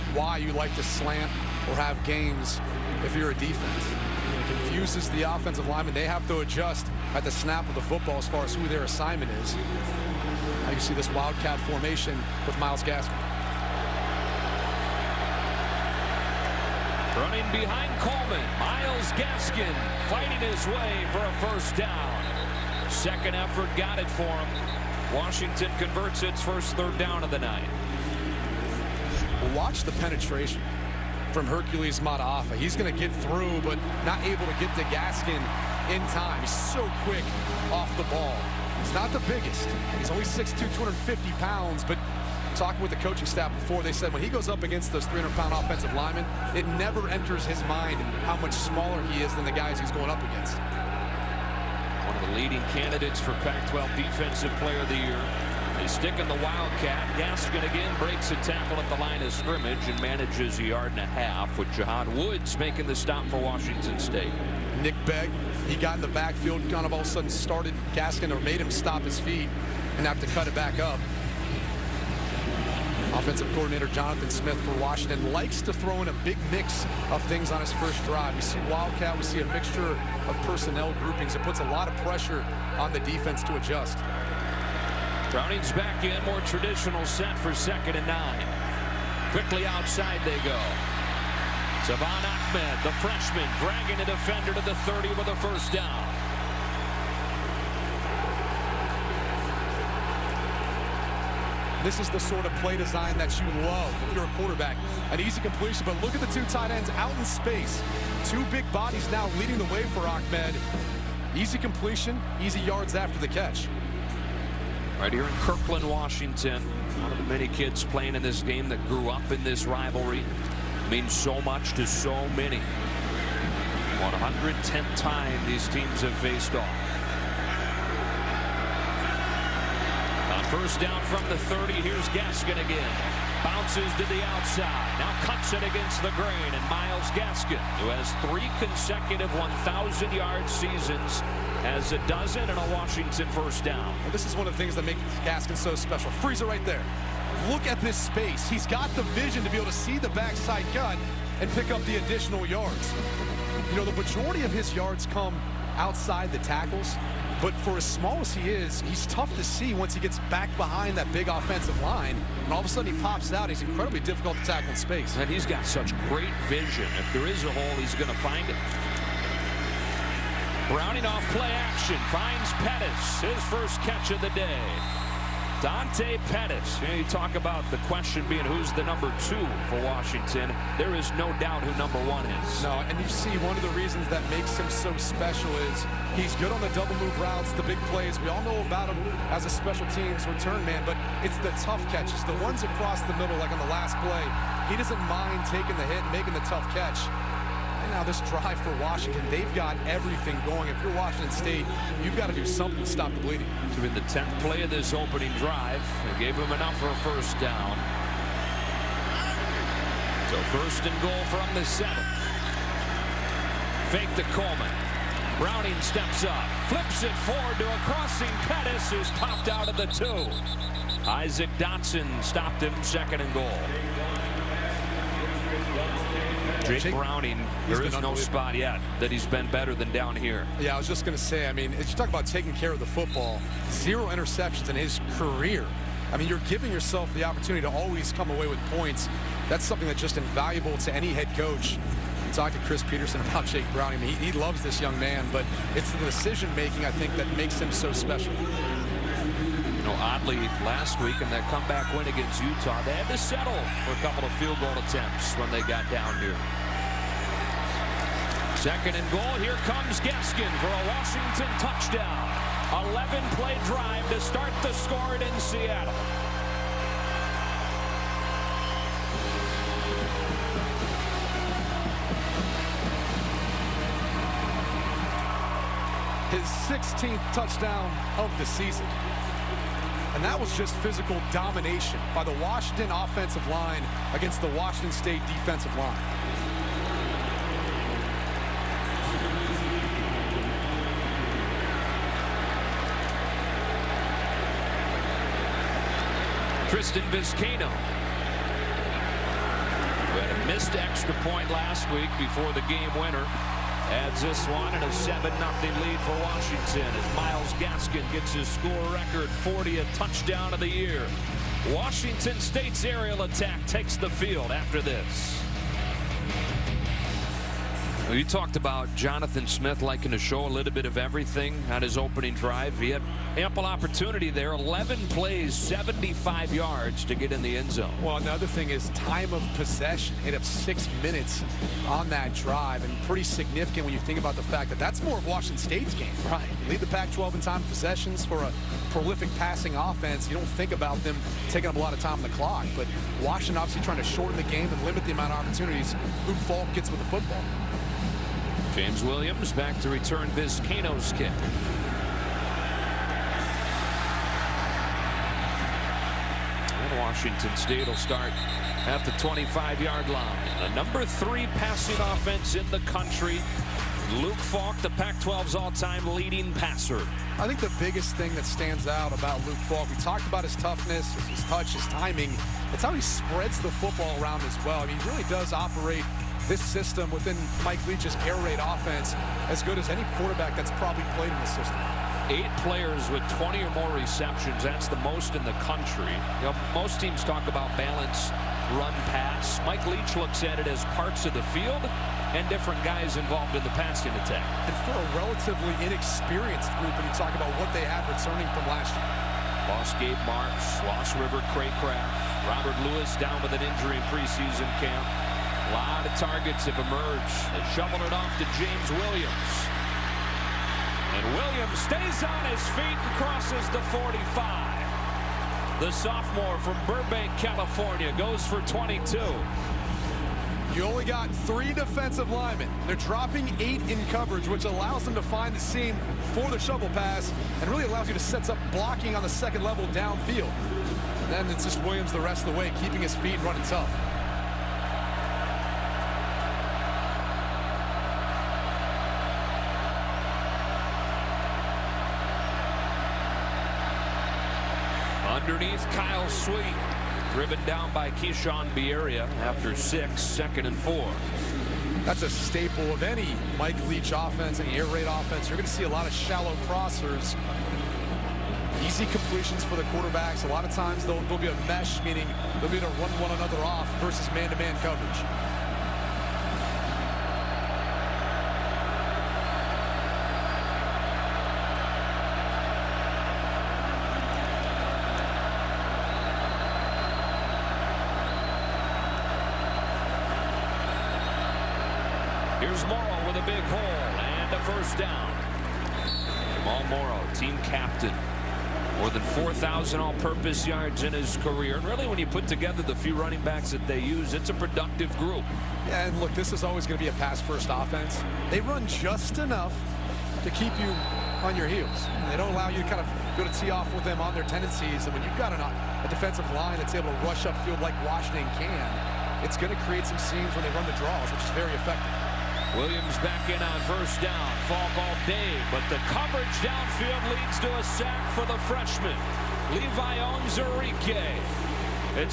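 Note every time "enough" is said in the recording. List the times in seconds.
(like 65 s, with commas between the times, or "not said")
206 s, 499 s.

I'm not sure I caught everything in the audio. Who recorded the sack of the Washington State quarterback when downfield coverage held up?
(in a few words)
Levi Onwuzurike.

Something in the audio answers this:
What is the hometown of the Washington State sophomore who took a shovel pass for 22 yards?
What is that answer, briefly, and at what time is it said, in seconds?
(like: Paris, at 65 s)
Burbank, California, at 416 s.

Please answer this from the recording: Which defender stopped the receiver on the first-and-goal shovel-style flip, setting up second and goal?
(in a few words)
Isaac Dotson.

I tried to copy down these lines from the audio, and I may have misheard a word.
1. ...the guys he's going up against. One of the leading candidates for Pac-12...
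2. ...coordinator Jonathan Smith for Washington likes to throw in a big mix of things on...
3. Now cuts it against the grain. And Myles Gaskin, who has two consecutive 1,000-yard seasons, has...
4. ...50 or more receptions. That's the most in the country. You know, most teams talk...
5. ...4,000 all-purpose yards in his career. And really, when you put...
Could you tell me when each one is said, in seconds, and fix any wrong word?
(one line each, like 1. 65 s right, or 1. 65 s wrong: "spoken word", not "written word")
1. 49 s right
2. 73 s right
3. 134 s wrong: "three", not "two"
4. 383 s wrong: "20", not "50"
5. 489 s right.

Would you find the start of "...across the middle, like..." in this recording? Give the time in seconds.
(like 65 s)
192 s.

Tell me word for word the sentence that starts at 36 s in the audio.
He's so quick off the ball.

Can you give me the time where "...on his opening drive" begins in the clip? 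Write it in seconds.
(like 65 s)
321 s.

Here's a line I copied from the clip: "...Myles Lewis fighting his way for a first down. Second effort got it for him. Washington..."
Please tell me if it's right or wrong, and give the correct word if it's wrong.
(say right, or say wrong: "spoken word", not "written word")
wrong: "Gaskin", not "Lewis".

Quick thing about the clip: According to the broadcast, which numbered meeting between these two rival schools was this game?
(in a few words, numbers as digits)
110th.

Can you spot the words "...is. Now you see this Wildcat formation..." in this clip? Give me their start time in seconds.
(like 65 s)
9 s.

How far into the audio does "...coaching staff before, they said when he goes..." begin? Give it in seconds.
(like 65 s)
42 s.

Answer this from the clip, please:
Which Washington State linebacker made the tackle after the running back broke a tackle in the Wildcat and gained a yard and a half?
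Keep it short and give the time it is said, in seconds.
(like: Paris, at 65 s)
Jahad Woods, at 61 s.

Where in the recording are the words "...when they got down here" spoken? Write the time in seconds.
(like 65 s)
255 s.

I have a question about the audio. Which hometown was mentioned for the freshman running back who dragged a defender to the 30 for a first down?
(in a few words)
Kirkland, Washington.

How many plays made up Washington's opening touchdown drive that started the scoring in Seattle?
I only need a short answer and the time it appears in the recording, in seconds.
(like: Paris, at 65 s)
11, at 262 s.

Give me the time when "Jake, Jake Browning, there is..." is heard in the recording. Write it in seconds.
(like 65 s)
226 s.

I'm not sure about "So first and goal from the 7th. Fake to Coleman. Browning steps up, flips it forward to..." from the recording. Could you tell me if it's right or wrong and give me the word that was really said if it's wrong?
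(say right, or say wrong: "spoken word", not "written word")
right.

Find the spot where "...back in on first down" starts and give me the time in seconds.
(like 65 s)
513 s.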